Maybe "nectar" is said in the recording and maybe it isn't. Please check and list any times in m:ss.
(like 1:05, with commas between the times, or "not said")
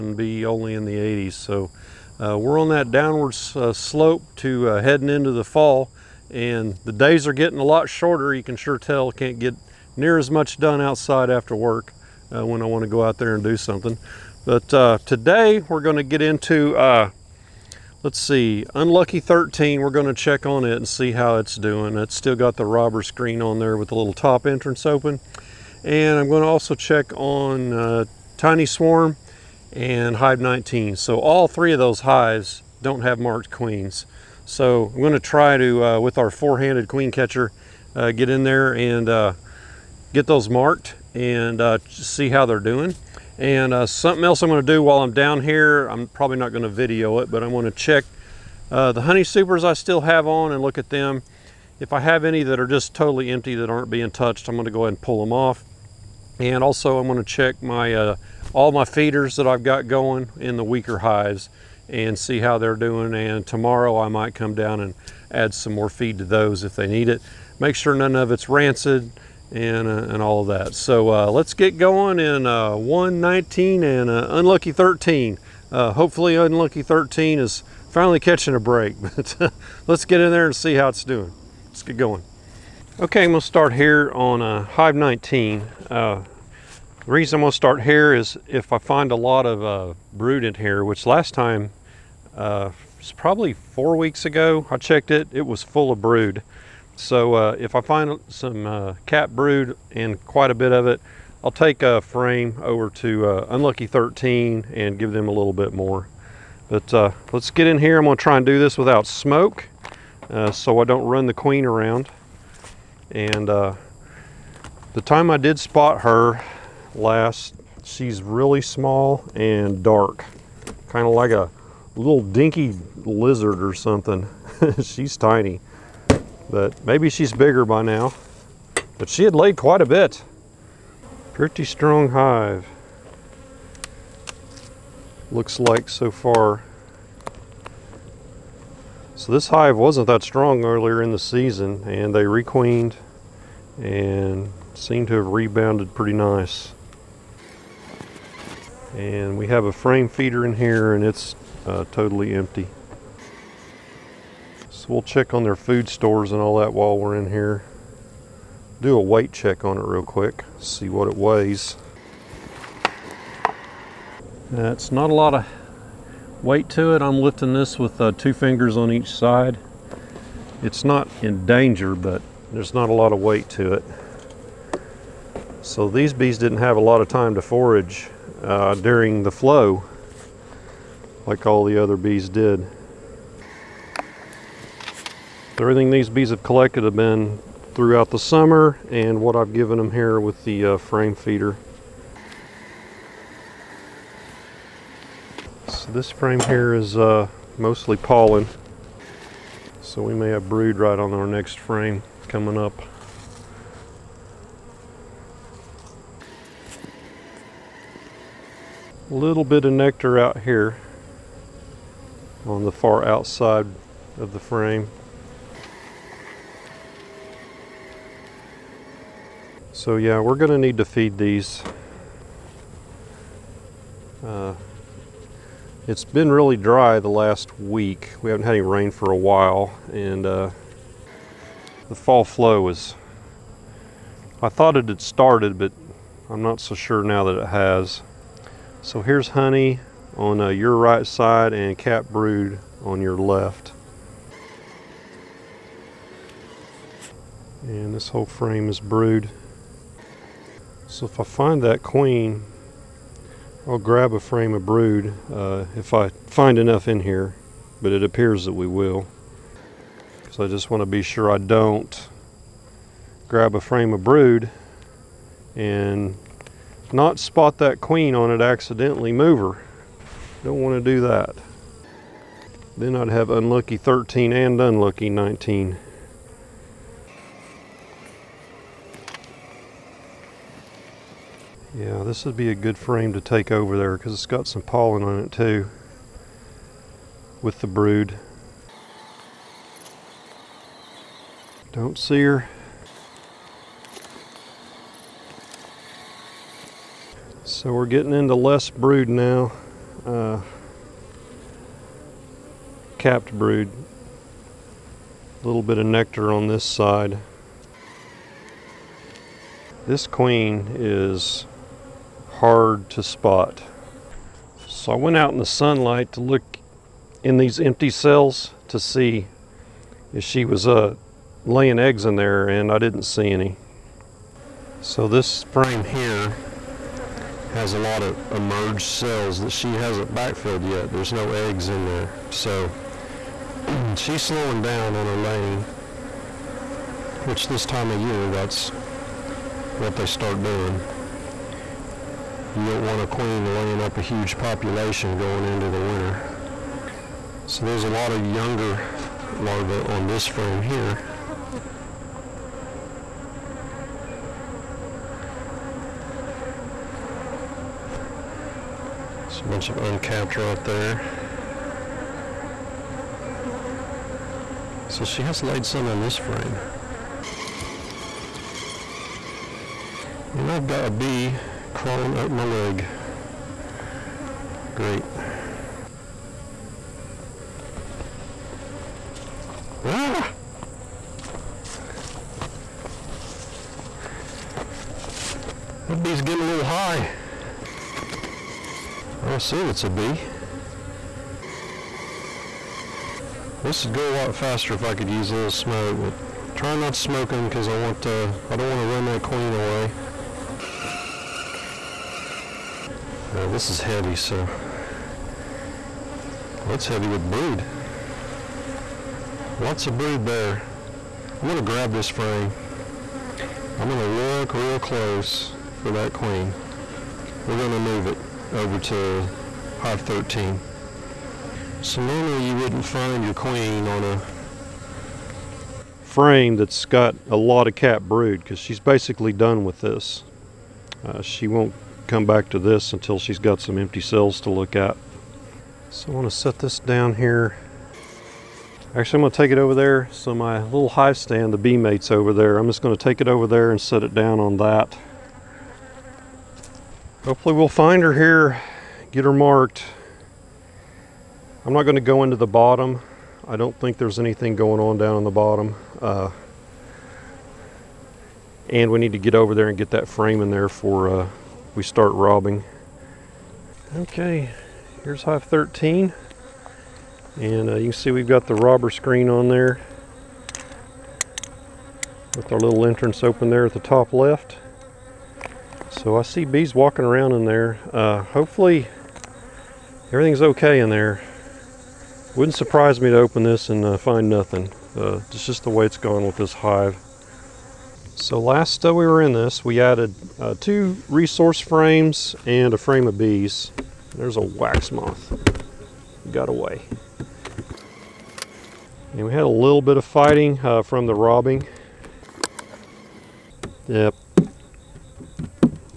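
3:29, 5:05.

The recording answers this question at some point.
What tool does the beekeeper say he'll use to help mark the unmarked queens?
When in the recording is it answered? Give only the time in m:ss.
0:36.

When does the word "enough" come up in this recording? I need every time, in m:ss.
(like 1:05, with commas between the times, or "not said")
4:16.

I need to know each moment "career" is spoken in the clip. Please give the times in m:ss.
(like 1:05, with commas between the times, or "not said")
not said.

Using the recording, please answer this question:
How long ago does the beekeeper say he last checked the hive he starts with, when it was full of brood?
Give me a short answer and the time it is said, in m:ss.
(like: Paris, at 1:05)
Four weeks, at 1:33.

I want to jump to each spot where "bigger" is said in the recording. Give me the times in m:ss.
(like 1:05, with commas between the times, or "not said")
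2:07.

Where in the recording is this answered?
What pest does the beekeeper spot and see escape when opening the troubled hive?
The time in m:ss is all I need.
8:14.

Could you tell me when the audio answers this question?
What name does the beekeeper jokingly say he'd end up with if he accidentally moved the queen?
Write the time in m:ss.
4:34.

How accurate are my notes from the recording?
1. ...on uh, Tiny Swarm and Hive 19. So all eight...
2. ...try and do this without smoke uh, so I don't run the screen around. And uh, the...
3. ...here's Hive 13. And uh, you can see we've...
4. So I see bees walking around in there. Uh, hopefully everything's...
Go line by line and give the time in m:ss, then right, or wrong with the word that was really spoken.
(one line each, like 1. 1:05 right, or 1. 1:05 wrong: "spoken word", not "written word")
1. 0:27 wrong: "three", not "eight"
2. 1:48 wrong: "queen", not "screen"
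3. 7:45 right
4. 7:55 right.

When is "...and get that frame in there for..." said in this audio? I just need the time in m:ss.
7:39.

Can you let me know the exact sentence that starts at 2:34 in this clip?
So we'll check on their food stores and all that while we're in here.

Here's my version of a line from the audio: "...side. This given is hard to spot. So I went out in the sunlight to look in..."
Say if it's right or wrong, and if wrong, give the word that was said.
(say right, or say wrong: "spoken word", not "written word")
wrong: "queen", not "given".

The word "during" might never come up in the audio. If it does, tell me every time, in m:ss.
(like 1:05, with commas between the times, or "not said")
2:58.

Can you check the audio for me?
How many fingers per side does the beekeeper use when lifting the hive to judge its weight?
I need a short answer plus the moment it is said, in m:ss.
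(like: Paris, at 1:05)
2, at 2:48.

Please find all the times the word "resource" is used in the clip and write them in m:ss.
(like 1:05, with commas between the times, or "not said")
8:11.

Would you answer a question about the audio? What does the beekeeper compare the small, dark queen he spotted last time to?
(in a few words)
A little dinky lizard.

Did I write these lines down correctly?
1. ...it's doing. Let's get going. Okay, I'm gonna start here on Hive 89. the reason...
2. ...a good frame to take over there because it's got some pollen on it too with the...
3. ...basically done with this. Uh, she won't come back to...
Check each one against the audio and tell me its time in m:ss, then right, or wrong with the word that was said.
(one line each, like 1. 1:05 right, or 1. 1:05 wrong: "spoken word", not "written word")
1. 1:20 wrong: "19", not "89"
2. 4:42 right
3. 7:08 right.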